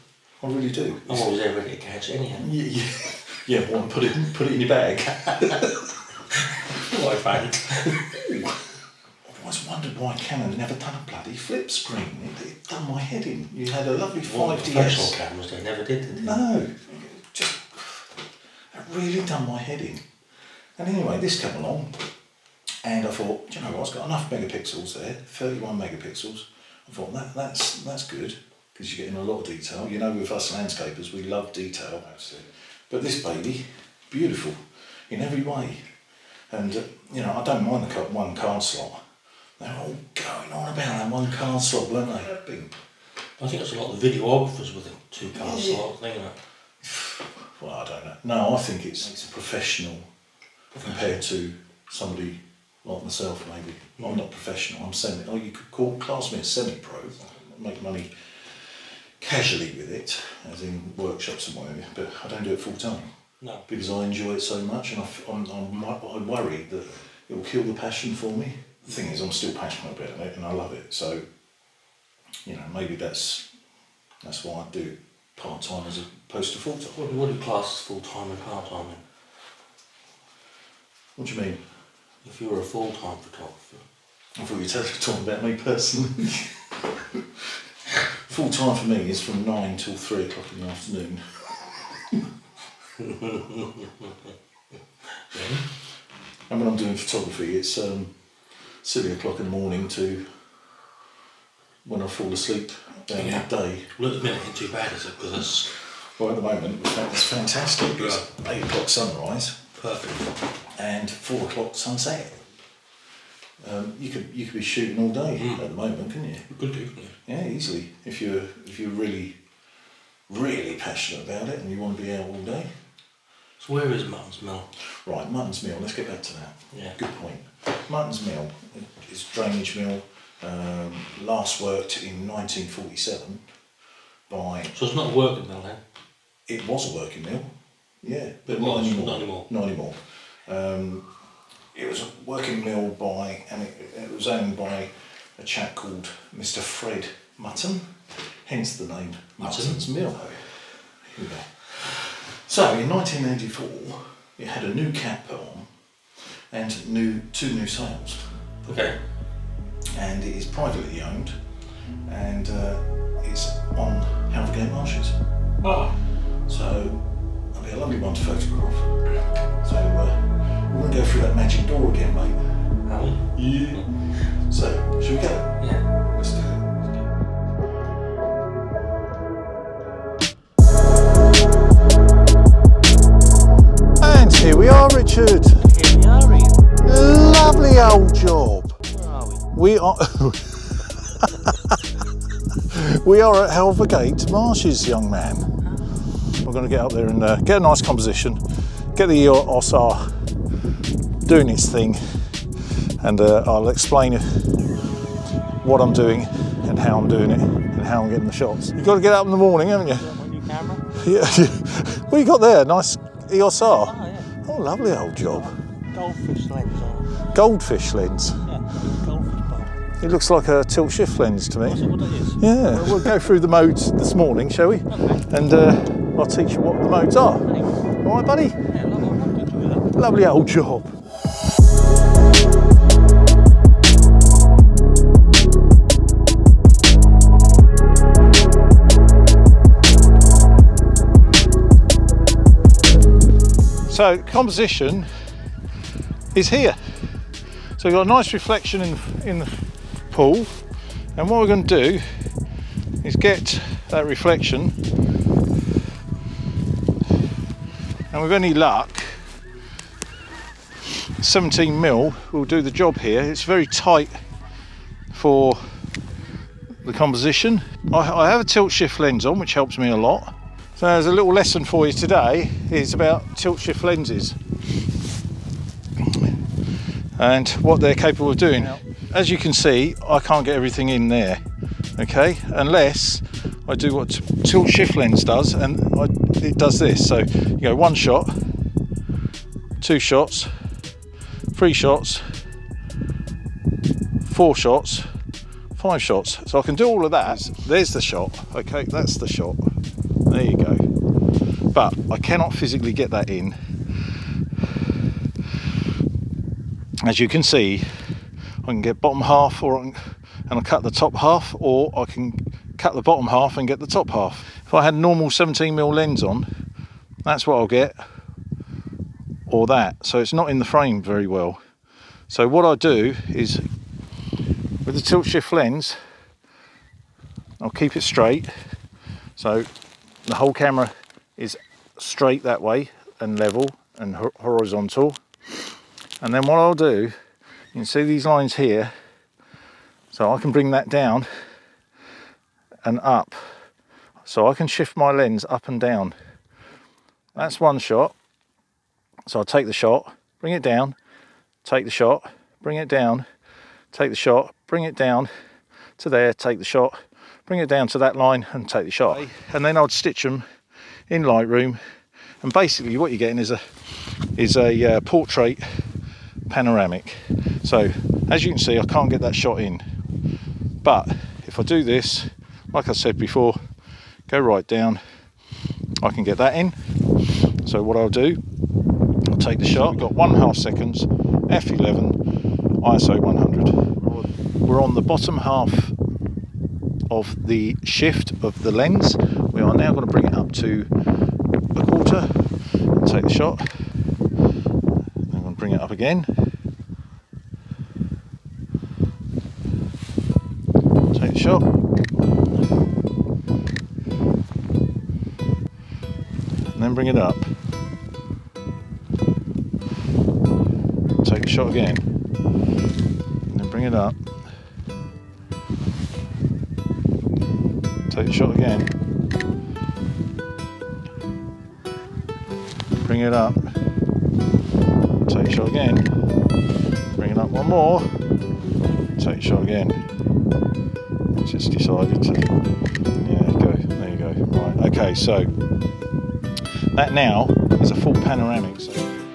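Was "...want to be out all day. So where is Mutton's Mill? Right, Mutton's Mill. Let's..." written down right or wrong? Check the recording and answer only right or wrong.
right.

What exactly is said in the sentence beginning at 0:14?
Professional cameras, they never did, did they?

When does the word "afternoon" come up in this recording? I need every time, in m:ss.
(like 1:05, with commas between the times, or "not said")
1:30.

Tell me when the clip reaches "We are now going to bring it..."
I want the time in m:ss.
6:29.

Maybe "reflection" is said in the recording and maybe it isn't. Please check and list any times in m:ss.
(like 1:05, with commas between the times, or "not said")
4:08, 4:14.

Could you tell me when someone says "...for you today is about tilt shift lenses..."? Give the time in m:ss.
4:31.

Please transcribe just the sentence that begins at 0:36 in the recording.
And, uh, you know, I don't mind the one card slot.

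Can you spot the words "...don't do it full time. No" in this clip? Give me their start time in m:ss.
1:02.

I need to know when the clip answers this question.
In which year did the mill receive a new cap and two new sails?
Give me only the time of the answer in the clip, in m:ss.
2:32.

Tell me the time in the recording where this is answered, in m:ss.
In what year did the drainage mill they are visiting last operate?
2:12.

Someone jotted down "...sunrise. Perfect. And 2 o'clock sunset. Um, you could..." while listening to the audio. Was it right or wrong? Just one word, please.
wrong.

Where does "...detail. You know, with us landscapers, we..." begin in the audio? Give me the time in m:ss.
0:29.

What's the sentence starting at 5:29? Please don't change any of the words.
So the whole camera is straight that way and level and horizontal.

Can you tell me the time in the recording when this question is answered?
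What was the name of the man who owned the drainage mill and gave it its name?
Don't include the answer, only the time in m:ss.
2:26.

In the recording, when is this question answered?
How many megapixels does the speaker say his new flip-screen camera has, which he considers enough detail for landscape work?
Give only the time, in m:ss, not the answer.
0:25.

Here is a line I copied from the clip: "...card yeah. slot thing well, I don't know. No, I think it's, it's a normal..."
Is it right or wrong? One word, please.
wrong.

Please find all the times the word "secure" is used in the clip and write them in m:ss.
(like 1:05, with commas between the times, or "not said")
not said.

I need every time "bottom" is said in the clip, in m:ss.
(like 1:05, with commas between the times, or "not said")
5:08, 5:13, 6:25.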